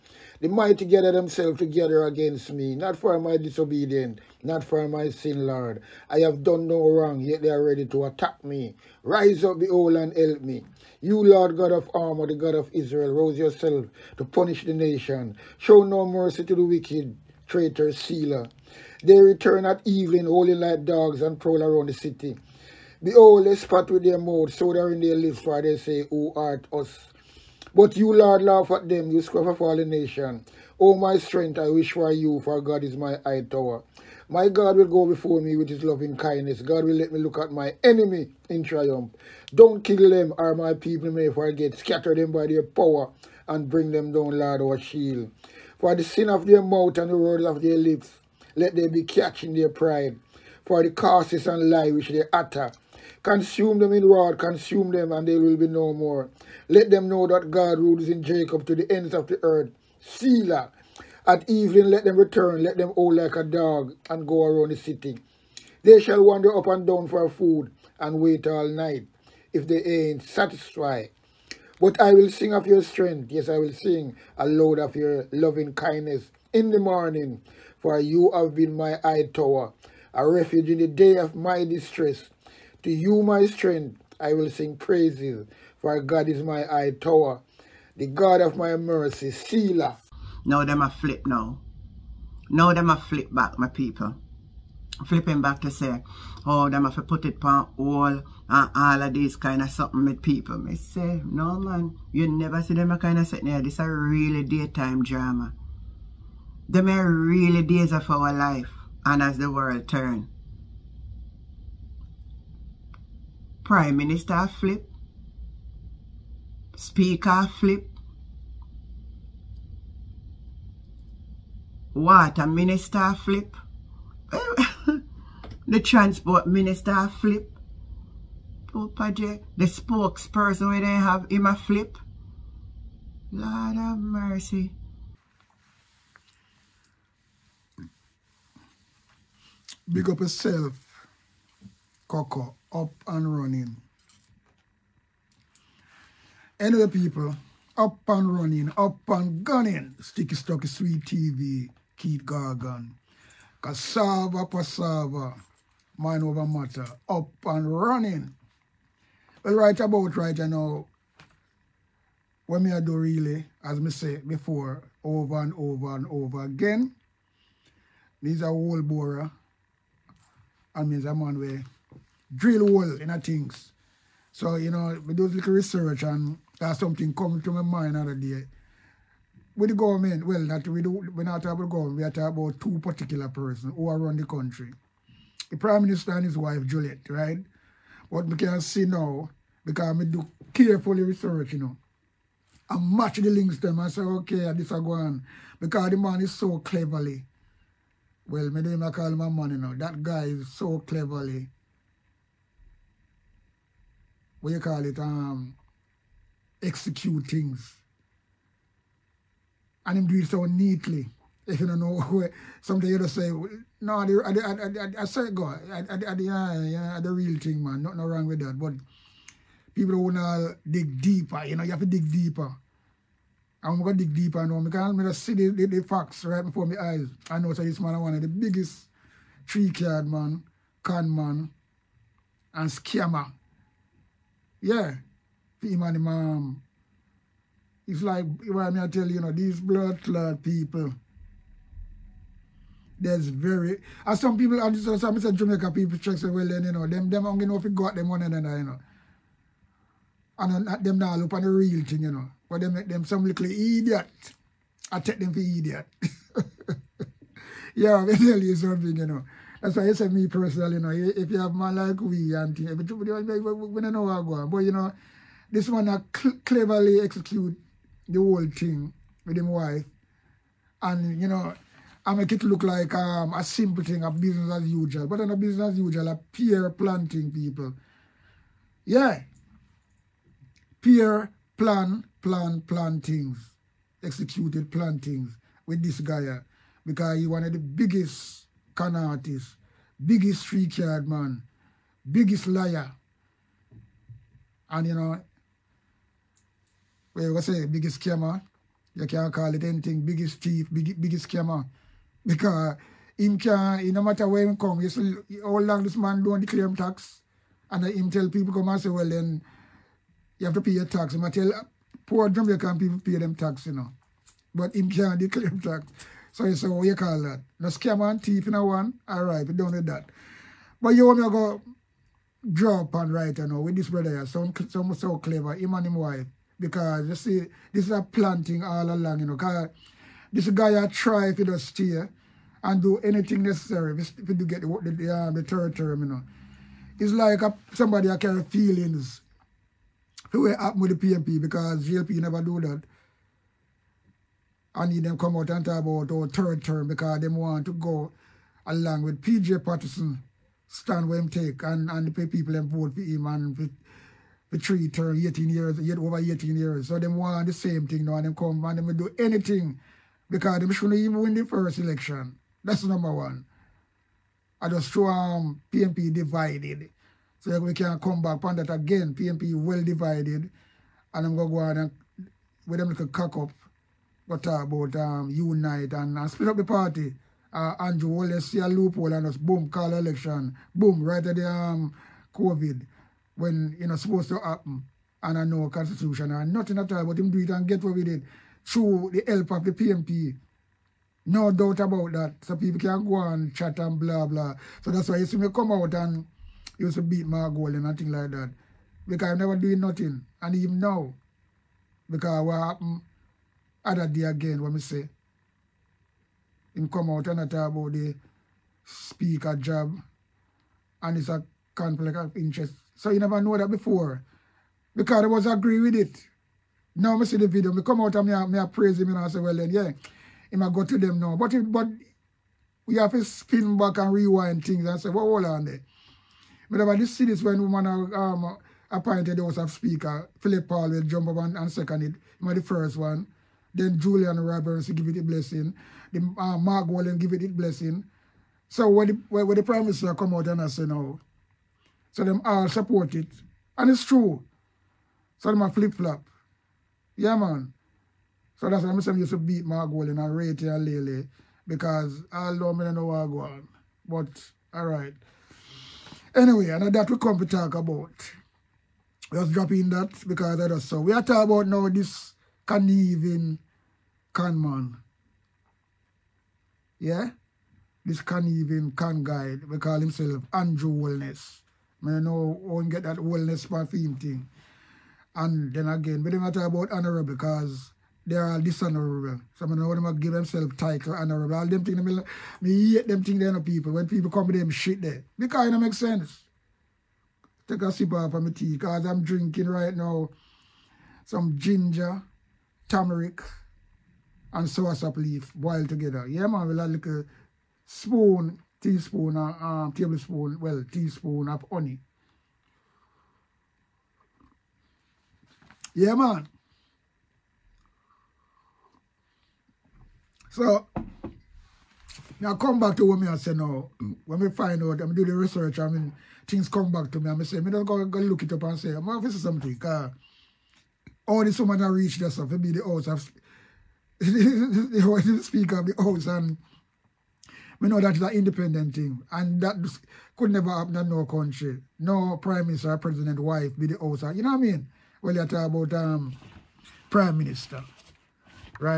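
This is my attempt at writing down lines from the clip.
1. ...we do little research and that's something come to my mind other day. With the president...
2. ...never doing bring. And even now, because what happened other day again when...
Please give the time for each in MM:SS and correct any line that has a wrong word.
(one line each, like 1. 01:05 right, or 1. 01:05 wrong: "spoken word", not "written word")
1. 02:55 wrong: "government", not "president"
2. 06:39 wrong: "nothing", not "bring".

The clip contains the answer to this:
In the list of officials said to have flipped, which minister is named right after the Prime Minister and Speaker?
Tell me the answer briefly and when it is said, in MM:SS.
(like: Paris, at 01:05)
Water Minister, at 02:01.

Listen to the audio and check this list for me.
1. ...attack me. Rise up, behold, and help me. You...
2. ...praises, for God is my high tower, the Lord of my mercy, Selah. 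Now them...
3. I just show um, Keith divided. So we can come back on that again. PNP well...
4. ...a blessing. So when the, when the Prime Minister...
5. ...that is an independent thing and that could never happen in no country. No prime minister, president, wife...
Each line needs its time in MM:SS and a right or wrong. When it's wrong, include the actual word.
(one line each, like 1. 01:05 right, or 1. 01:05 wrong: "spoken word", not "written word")
1. 00:08 right
2. 01:24 wrong: "God", not "Lord"
3. 06:04 wrong: "PNP", not "Keith"
4. 07:17 right
5. 08:48 right.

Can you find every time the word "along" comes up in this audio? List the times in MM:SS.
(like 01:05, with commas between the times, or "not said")
05:28, 05:48.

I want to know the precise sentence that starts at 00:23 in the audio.
Behold, they spat with their mouth, so they in their lips, for they say, Who art us?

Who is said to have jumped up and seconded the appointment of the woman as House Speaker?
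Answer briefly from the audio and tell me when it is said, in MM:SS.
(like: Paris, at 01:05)
Phillip Paulwell, at 07:10.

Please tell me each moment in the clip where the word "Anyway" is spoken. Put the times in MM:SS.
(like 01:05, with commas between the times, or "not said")
02:26, 07:36.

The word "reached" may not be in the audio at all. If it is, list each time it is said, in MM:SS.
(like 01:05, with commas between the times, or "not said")
08:41.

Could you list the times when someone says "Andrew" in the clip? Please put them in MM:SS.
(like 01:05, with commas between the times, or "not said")
06:17, 07:50.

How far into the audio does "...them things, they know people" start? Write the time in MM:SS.
08:03.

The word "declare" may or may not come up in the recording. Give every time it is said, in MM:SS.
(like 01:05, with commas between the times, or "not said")
05:06, 05:15.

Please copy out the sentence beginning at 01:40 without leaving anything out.
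Me say, no man, you never see them a kind of sitting here.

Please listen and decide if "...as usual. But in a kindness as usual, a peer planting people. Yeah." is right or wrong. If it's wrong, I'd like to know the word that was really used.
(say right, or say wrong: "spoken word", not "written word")
wrong: "business", not "kindness".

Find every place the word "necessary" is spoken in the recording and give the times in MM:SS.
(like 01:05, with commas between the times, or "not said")
05:33.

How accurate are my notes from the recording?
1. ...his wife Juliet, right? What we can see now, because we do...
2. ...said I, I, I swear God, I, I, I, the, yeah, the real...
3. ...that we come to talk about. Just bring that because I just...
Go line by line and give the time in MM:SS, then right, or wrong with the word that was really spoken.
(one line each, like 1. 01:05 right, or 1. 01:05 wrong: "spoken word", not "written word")
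1. 03:06 right
2. 03:34 right
3. 07:36 wrong: "dropping", not "bring".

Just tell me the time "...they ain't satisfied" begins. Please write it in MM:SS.
01:09.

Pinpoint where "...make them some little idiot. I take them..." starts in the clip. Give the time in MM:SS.
04:12.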